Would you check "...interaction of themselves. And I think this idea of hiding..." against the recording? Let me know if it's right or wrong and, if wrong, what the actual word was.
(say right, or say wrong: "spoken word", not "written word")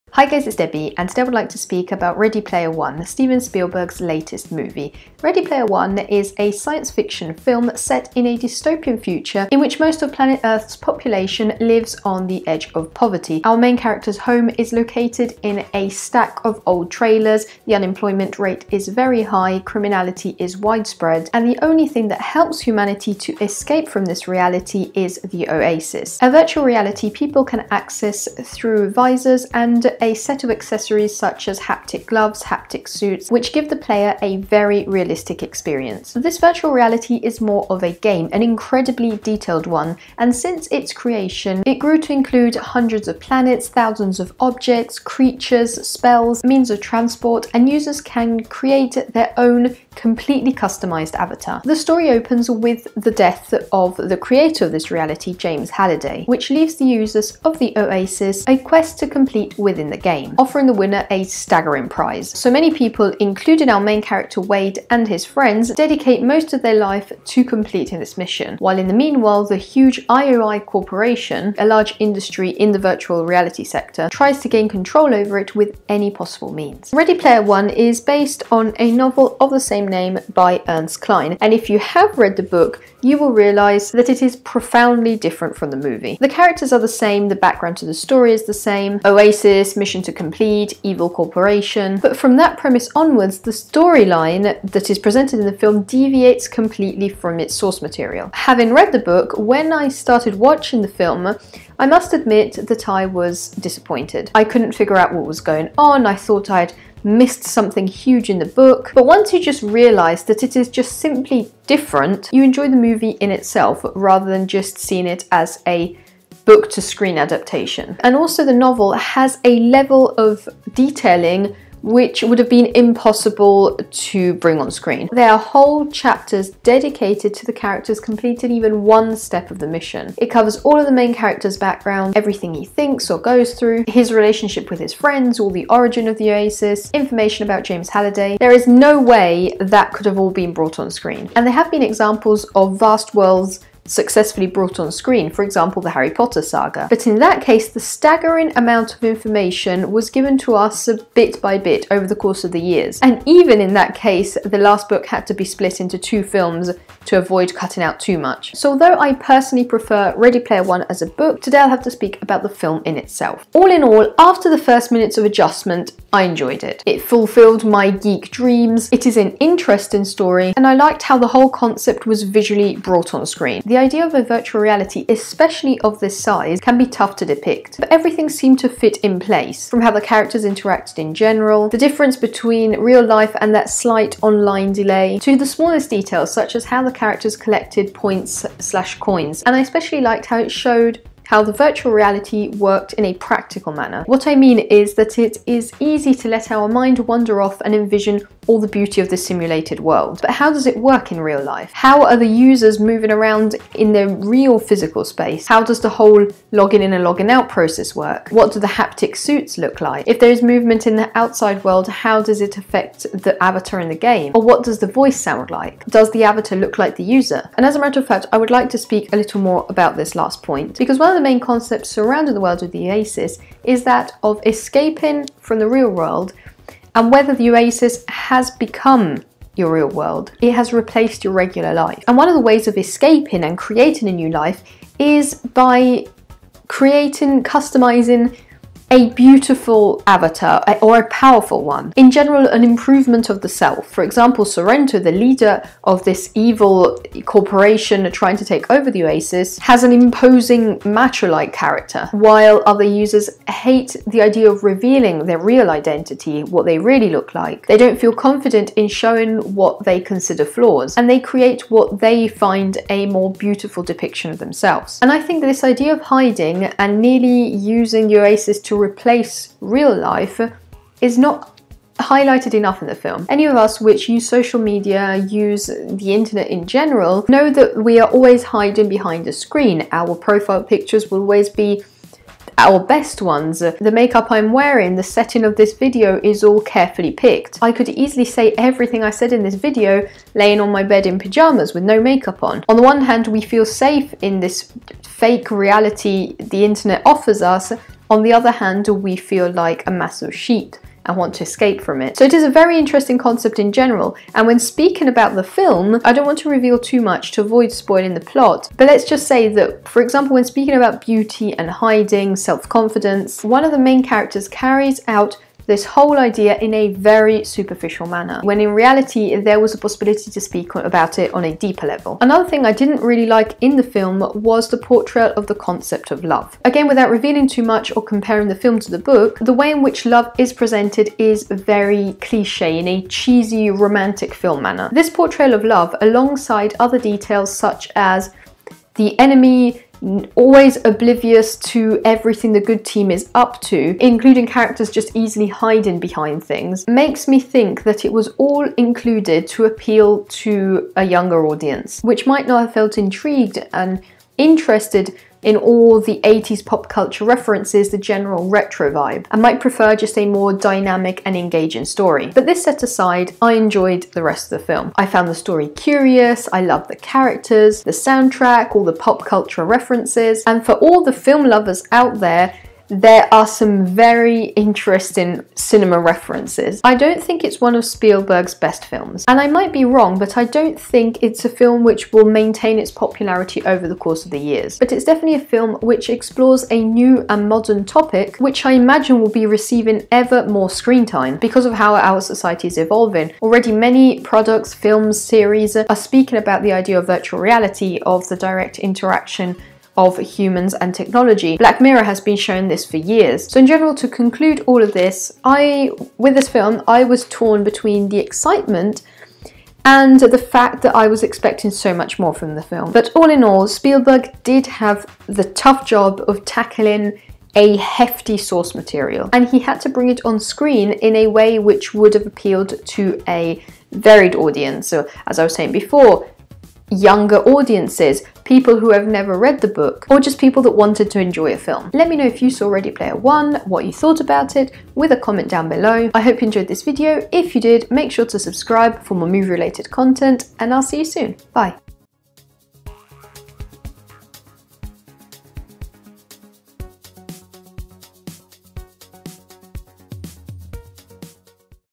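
wrong: "depiction", not "interaction".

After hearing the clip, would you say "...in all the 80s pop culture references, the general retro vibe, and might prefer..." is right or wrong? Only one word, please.
right.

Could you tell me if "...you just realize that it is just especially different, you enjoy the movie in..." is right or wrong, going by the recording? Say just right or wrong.
wrong.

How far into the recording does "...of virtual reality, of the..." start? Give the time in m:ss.
6:36.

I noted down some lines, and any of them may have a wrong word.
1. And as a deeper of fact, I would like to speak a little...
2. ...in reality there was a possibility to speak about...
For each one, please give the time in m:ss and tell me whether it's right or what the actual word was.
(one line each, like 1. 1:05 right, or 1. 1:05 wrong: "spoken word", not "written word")
1. 3:37 wrong: "matter", not "deeper"
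2. 5:18 right.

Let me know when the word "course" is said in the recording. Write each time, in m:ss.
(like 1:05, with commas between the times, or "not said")
2:32, 6:23.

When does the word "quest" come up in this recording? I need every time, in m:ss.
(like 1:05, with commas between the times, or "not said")
0:58.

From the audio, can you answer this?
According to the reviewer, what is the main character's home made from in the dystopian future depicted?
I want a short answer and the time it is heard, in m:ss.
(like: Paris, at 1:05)
A stack of old trailers, at 0:15.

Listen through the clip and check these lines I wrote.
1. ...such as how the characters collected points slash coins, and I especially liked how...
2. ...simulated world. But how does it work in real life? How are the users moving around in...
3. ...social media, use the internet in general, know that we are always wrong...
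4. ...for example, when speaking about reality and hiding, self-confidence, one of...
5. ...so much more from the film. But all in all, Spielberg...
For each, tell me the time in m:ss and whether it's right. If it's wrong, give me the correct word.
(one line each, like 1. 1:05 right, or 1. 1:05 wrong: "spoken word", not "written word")
1. 3:06 right
2. 3:19 right
3. 4:34 wrong: "hiding", not "wrong"
4. 5:09 wrong: "beauty", not "reality"
5. 6:51 right.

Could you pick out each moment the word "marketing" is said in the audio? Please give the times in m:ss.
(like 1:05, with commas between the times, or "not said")
not said.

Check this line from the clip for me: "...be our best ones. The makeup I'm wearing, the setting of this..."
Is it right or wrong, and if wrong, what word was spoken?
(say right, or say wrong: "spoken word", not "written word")
right.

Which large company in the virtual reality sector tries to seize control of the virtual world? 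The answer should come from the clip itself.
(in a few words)
IOI Corporation.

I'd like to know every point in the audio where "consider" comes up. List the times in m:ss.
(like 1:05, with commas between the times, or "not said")
4:20.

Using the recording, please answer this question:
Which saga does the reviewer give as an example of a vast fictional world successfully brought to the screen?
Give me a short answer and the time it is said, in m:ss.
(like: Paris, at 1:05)
Harry Potter, at 2:25.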